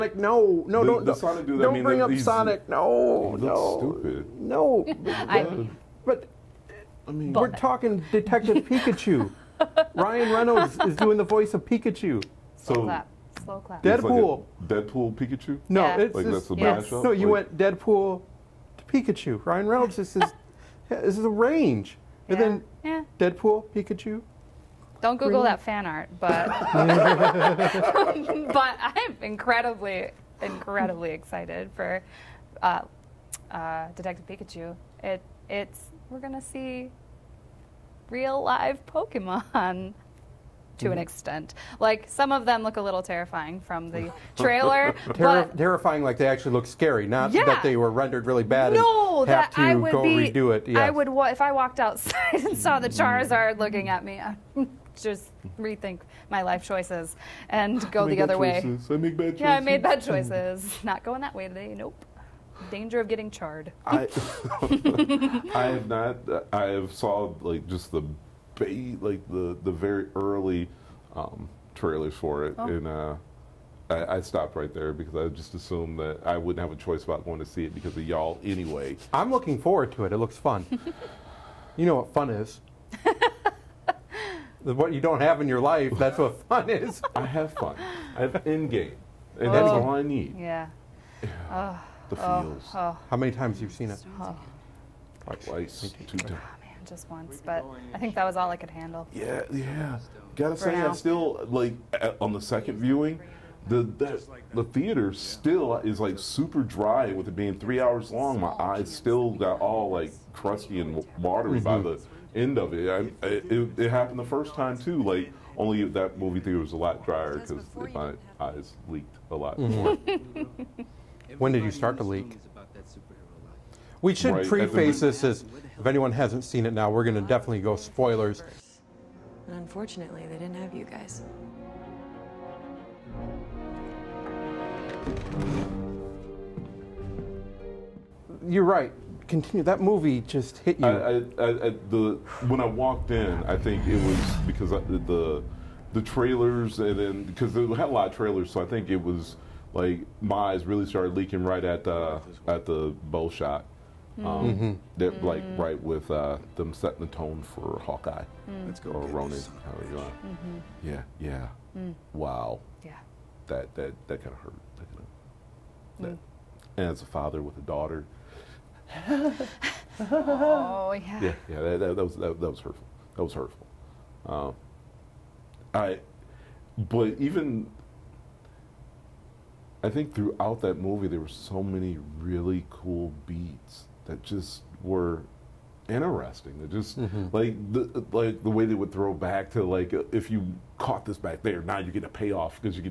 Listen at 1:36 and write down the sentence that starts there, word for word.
Two times just once, but I think that was all I could handle.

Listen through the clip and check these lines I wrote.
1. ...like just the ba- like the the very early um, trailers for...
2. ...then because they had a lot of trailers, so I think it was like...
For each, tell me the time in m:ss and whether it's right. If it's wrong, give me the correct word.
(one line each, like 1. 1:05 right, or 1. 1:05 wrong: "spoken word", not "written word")
1. 1:07 right
2. 2:26 right.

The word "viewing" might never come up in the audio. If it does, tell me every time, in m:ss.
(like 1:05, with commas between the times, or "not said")
1:42.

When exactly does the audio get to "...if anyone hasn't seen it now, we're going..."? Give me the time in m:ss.
2:05.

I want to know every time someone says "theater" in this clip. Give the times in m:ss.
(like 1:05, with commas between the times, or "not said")
1:44, 1:56.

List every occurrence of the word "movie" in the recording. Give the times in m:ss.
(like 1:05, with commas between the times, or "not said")
1:56, 2:19, 3:00.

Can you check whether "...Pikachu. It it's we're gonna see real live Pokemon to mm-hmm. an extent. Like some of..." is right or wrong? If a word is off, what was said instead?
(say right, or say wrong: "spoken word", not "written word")
right.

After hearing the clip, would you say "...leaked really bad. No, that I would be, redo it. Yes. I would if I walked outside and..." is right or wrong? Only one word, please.
wrong.